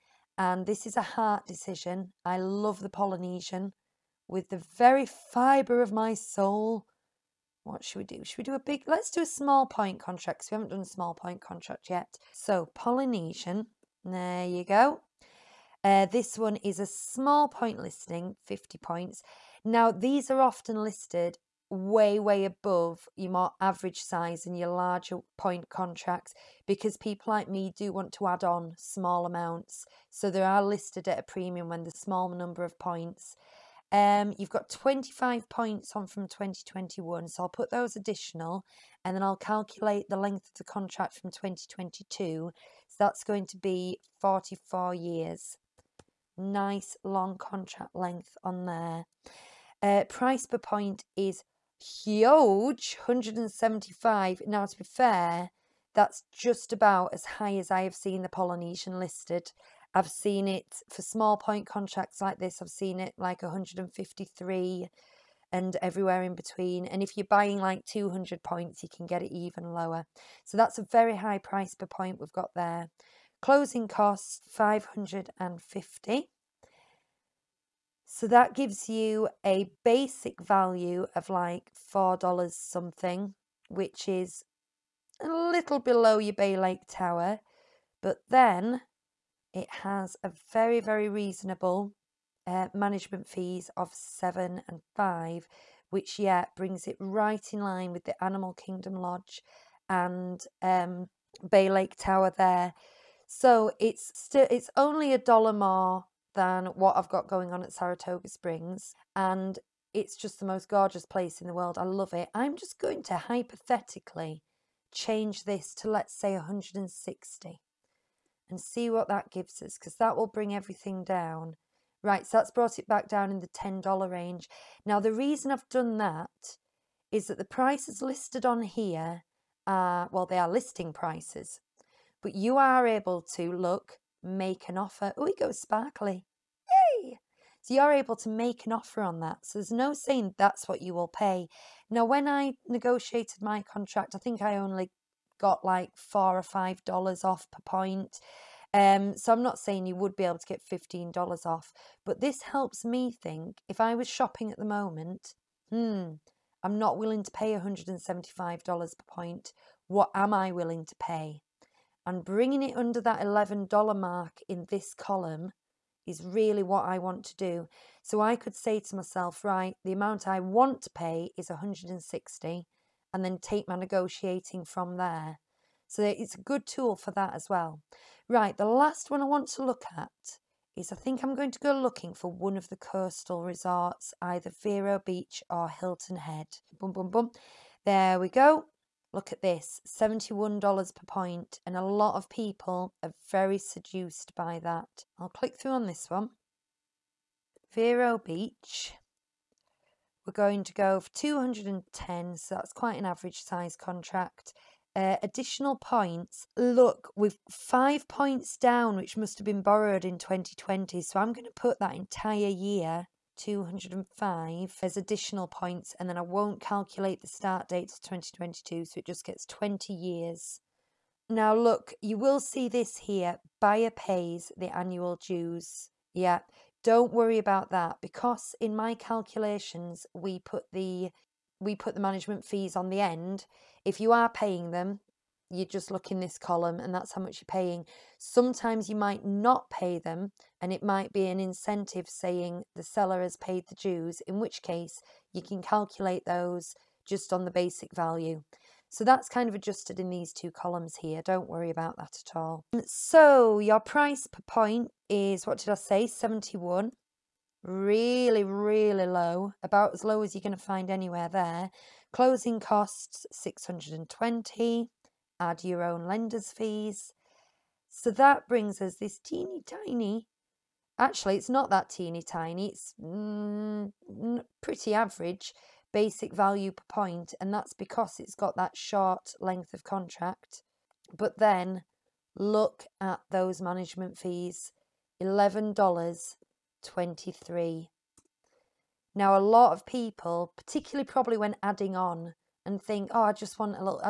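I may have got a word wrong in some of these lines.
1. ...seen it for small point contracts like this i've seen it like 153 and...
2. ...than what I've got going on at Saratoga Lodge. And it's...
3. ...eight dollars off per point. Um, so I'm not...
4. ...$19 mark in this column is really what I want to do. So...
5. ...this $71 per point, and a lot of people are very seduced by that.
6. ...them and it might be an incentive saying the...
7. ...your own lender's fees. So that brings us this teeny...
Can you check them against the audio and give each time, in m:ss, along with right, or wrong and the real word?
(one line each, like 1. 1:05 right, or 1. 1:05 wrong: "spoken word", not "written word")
1. 1:00 right
2. 1:46 wrong: "Springs", not "Lodge"
3. 2:26 wrong: "five", not "eight"
4. 2:43 wrong: "11", not "19"
5. 3:09 right
6. 3:59 right
7. 4:25 right.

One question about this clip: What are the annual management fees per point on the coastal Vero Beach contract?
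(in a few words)
$11.23.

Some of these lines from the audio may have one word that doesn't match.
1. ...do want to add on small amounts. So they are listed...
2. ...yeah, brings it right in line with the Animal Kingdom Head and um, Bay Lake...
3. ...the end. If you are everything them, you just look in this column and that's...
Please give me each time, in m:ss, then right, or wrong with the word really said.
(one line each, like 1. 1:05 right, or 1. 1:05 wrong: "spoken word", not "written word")
1. 0:27 right
2. 1:36 wrong: "Lodge", not "Head"
3. 3:52 wrong: "paying", not "everything".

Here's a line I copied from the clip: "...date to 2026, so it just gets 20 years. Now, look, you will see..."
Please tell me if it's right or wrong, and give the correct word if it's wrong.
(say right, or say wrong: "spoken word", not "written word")
wrong: "2022", not "2026".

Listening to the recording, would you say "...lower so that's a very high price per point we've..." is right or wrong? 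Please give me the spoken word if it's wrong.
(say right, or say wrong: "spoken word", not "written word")
right.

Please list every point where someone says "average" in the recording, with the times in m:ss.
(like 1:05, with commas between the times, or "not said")
0:23, 3:23, 4:34.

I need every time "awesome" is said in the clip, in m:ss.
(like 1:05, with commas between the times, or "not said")
not said.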